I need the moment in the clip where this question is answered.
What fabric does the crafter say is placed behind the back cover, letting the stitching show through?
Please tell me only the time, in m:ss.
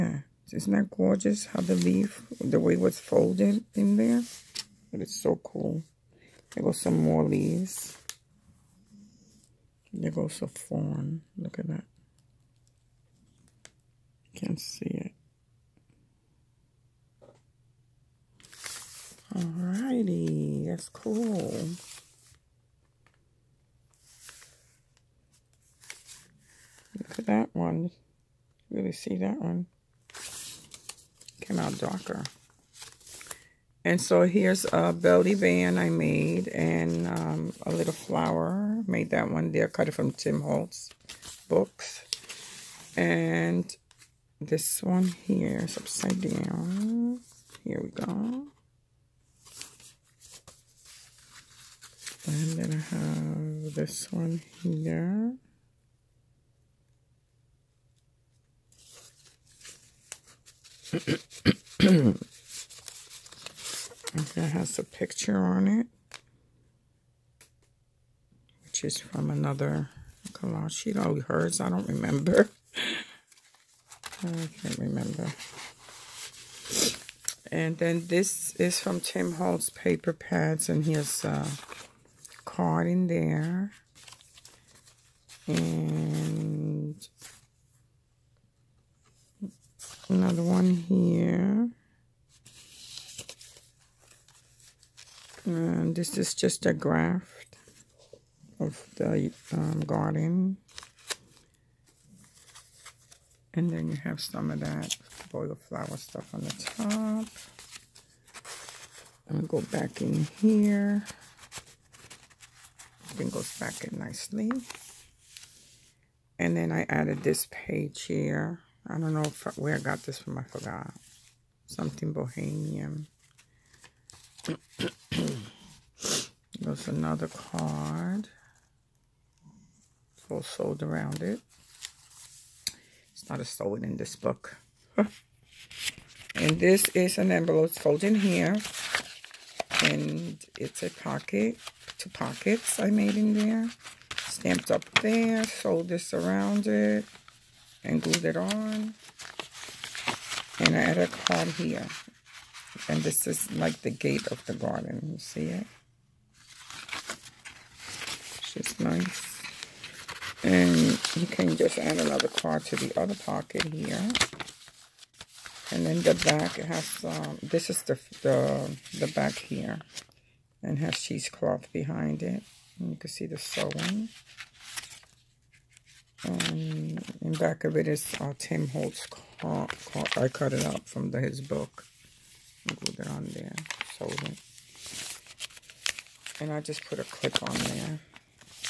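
2:50.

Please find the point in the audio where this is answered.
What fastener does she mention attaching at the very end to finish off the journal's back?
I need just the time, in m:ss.
3:06.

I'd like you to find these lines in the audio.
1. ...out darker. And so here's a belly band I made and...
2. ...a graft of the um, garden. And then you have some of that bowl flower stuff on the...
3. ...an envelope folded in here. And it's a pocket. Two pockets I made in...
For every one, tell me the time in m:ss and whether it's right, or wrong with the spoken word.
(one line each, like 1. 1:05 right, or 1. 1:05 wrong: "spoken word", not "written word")
1. 0:31 right
2. 1:36 right
3. 2:17 right.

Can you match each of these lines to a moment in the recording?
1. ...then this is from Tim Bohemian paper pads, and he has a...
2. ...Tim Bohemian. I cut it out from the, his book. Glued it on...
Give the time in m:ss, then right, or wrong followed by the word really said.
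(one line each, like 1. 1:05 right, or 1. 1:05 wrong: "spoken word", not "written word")
1. 1:17 wrong: "Holtz", not "Bohemian"
2. 2:58 wrong: "Holtz", not "Bohemian".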